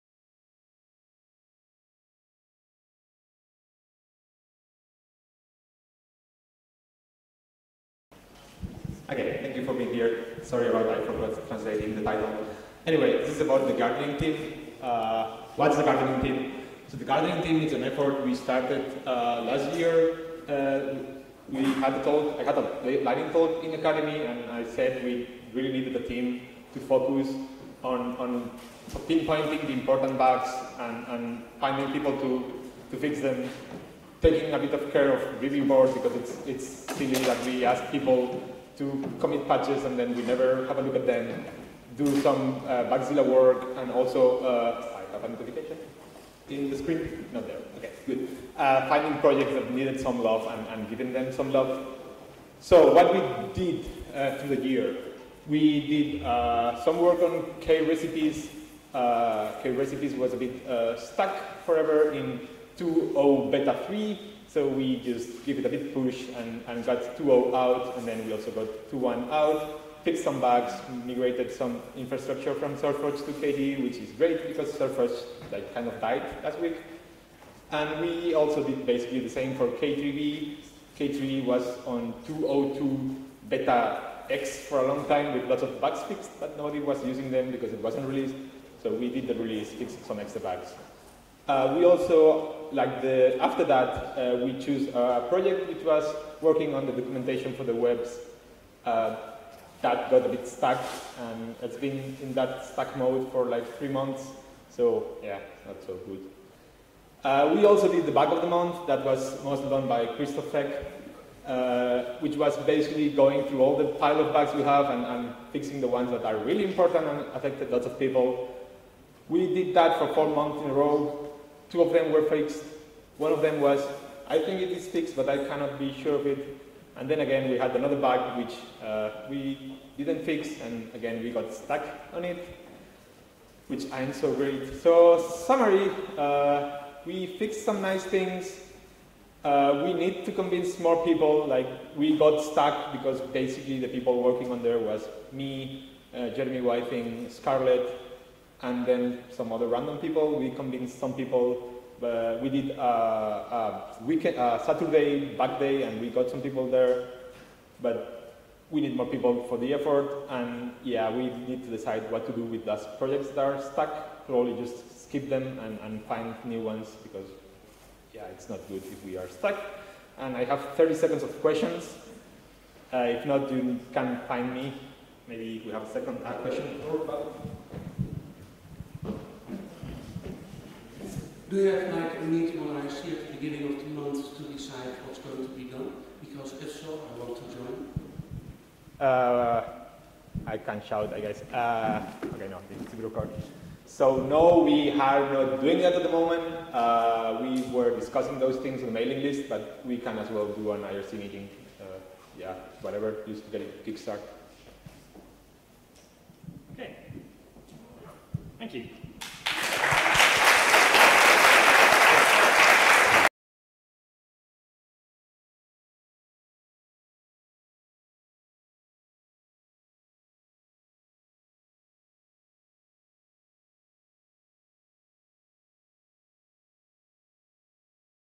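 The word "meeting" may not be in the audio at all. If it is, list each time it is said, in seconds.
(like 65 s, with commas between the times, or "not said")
182 s, 201 s.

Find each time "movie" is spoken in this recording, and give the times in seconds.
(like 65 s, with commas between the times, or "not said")
not said.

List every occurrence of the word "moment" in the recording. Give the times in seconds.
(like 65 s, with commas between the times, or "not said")
196 s.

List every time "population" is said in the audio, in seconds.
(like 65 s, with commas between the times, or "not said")
not said.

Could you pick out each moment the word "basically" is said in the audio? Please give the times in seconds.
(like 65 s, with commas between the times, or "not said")
78 s, 112 s, 143 s.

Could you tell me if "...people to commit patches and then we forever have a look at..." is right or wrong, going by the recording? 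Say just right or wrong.
wrong.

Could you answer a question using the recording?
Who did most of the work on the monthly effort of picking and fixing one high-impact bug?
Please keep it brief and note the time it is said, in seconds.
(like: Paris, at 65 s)
Christoph Feck, at 110 s.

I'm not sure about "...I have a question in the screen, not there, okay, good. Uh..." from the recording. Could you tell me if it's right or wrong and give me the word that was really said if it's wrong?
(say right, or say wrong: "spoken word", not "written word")
wrong: "notification", not "question".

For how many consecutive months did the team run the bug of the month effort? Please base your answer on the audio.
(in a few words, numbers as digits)
4.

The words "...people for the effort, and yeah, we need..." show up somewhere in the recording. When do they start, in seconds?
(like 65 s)
159 s.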